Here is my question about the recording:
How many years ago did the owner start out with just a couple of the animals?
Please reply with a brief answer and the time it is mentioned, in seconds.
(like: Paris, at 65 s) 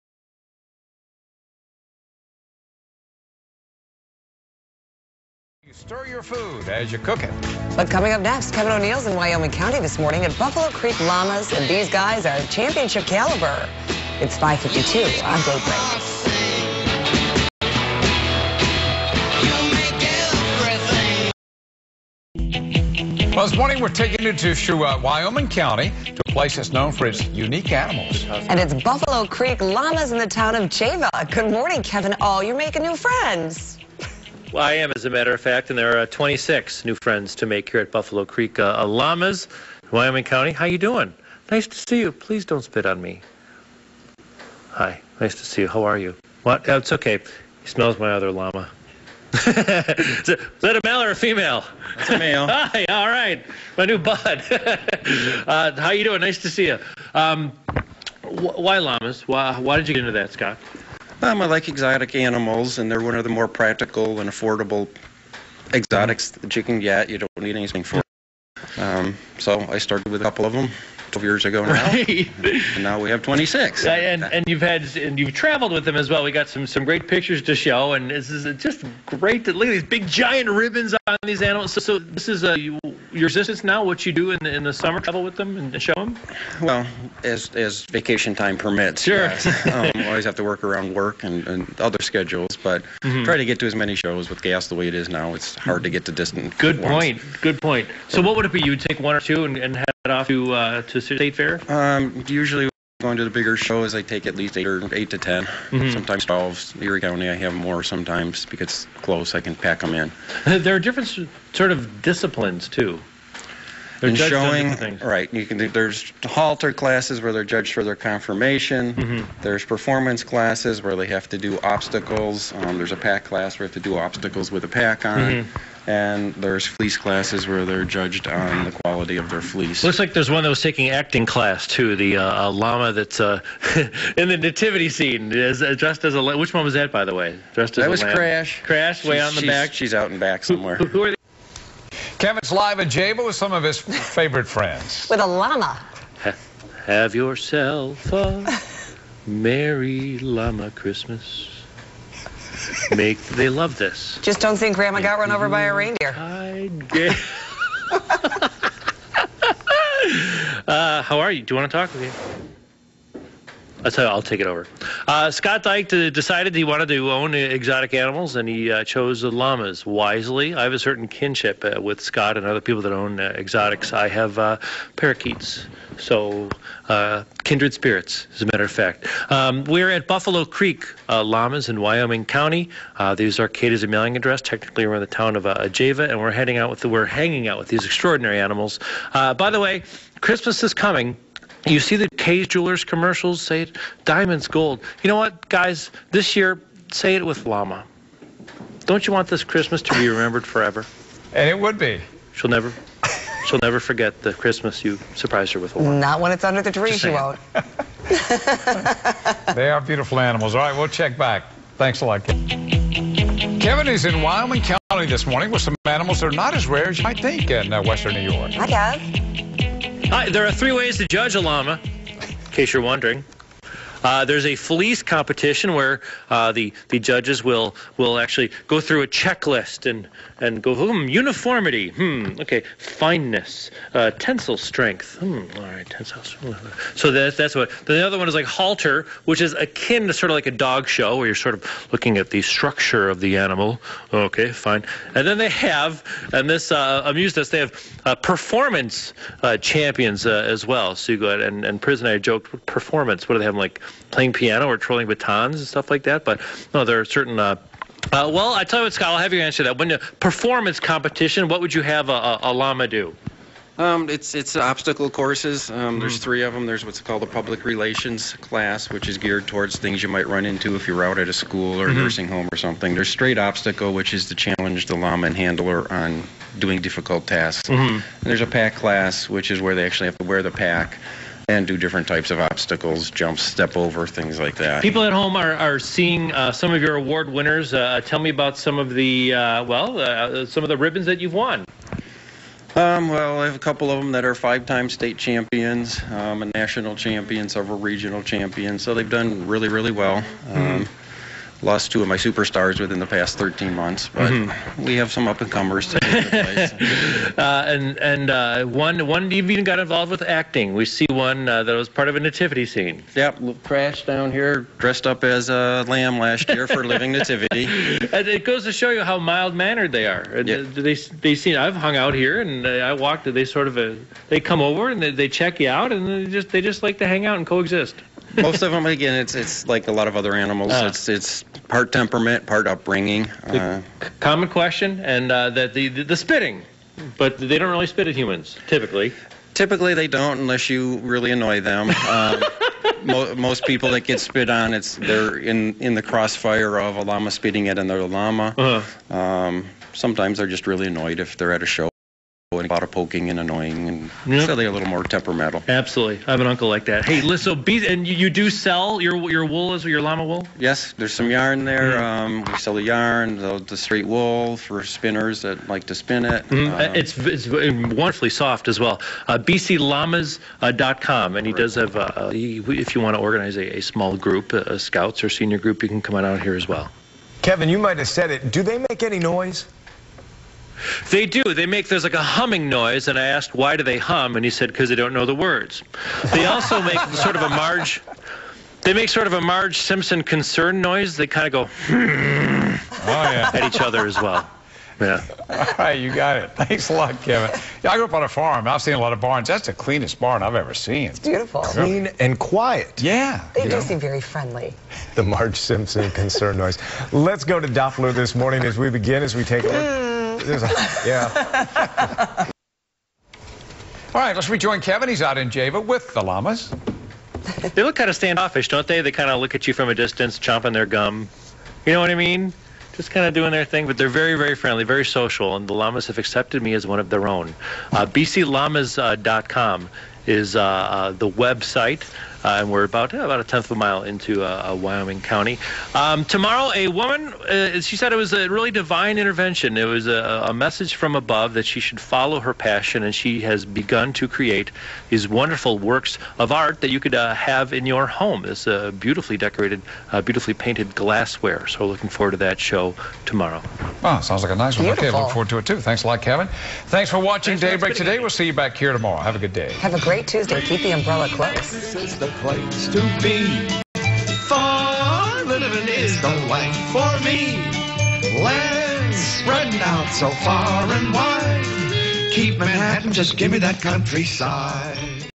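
12, at 71 s.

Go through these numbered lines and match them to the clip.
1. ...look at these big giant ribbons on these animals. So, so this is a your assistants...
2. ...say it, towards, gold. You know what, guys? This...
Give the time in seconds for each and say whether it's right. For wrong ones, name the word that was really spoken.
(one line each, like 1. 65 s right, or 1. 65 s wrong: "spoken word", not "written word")
1. 79 s right
2. 193 s wrong: "diamonds", not "towards".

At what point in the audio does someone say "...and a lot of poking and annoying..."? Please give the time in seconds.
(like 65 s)
352 s.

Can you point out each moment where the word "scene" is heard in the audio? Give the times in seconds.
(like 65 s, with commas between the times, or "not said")
134 s, 312 s.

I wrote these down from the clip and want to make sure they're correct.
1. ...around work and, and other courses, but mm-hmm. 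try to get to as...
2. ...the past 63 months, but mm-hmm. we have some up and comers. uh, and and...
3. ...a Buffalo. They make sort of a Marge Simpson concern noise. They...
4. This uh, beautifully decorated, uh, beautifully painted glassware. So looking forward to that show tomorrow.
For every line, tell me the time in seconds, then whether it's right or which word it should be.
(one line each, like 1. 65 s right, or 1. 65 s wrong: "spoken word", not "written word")
1. 90 s wrong: "schedules", not "courses"
2. 302 s wrong: "13", not "63"
3. 387 s wrong: "Marge", not "Buffalo"
4. 448 s right.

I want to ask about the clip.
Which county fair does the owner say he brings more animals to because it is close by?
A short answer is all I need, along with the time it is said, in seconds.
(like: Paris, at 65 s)
Erie County, at 106 s.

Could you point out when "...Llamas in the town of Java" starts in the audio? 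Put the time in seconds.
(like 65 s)
29 s.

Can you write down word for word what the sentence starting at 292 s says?
Um, well, I have a couple of them that are five-time state champions, um, a national champion, several regional champions.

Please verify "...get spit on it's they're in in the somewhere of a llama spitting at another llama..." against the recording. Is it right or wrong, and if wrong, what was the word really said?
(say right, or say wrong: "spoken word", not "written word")
wrong: "crossfire", not "somewhere".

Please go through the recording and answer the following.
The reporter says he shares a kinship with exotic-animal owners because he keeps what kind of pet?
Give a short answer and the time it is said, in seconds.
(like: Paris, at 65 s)
Parakeets, at 174 s.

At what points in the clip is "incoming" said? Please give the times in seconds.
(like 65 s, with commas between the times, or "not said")
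not said.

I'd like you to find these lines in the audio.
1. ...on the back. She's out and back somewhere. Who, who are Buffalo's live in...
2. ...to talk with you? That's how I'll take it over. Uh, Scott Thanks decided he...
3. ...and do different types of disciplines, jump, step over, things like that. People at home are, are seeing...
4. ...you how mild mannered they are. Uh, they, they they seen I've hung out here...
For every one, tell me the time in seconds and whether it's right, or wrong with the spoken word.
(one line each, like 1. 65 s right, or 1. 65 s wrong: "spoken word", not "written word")
1. 139 s wrong: "Kevin", not "Buffalo"
2. 161 s wrong: "Dyke", not "Thanks"
3. 281 s wrong: "obstacles", not "disciplines"
4. 318 s right.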